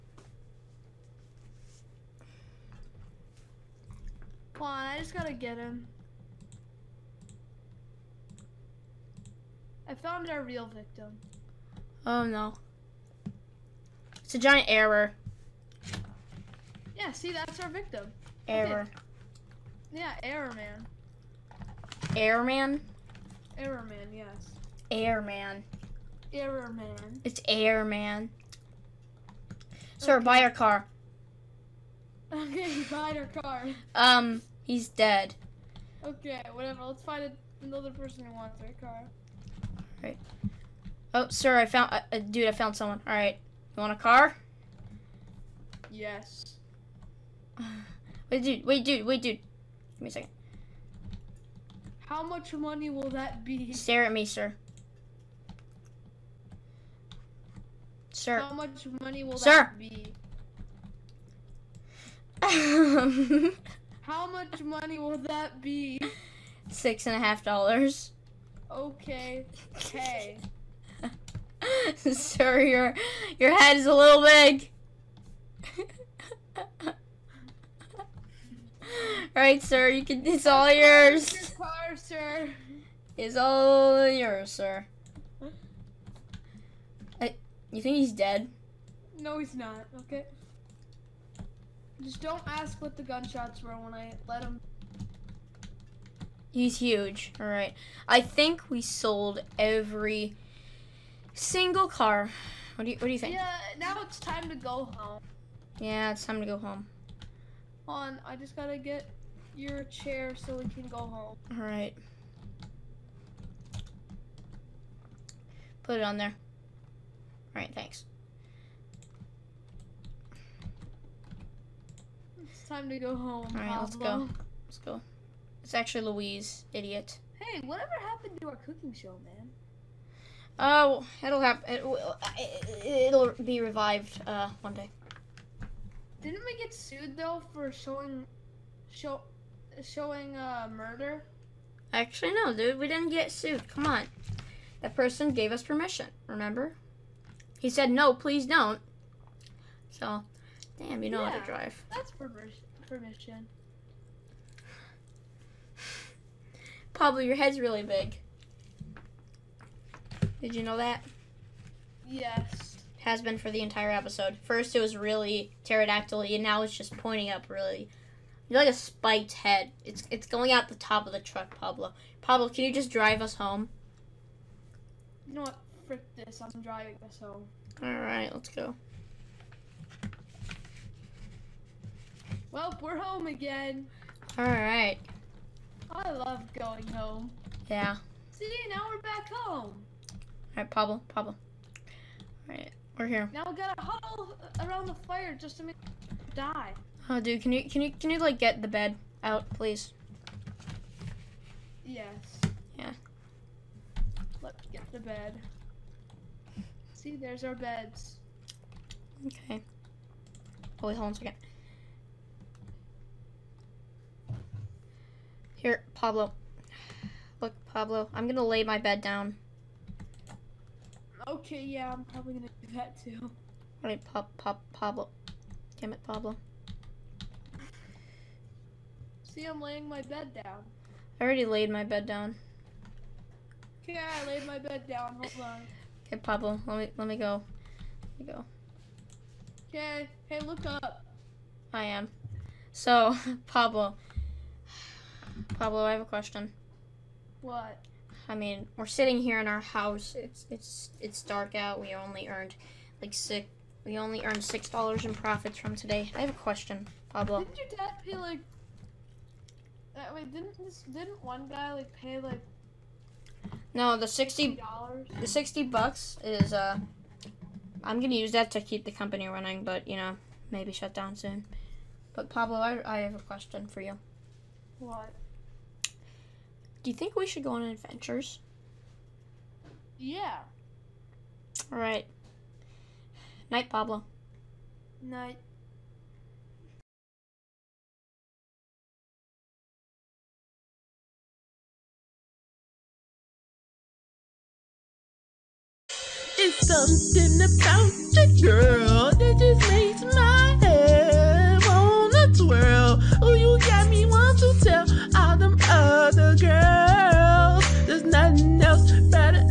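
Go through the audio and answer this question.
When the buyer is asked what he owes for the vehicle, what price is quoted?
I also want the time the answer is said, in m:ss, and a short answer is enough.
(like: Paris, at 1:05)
$6.50, at 1:06.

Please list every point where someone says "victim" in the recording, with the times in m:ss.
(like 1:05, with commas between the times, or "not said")
0:10, 0:17.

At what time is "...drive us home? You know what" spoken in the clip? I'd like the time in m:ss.
2:52.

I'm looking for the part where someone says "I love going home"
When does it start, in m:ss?
3:05.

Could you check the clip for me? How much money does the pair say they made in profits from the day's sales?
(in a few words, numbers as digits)
$6.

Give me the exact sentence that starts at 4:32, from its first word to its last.
But Pablo, I, I have a question for you.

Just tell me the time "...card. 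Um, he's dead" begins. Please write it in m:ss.
0:33.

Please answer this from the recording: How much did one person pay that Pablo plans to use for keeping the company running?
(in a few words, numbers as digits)
$60.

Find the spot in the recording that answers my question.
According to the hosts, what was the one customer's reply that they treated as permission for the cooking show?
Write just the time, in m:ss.
2:27.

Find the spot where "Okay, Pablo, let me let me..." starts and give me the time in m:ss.
3:56.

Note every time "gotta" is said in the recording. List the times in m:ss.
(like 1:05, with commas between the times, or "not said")
0:05, 1:48, 3:13.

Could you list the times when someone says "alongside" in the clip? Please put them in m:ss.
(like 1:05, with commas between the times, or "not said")
not said.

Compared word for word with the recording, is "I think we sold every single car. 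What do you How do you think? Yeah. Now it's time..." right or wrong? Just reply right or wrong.
wrong.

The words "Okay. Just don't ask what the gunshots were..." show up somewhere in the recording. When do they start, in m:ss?
1:30.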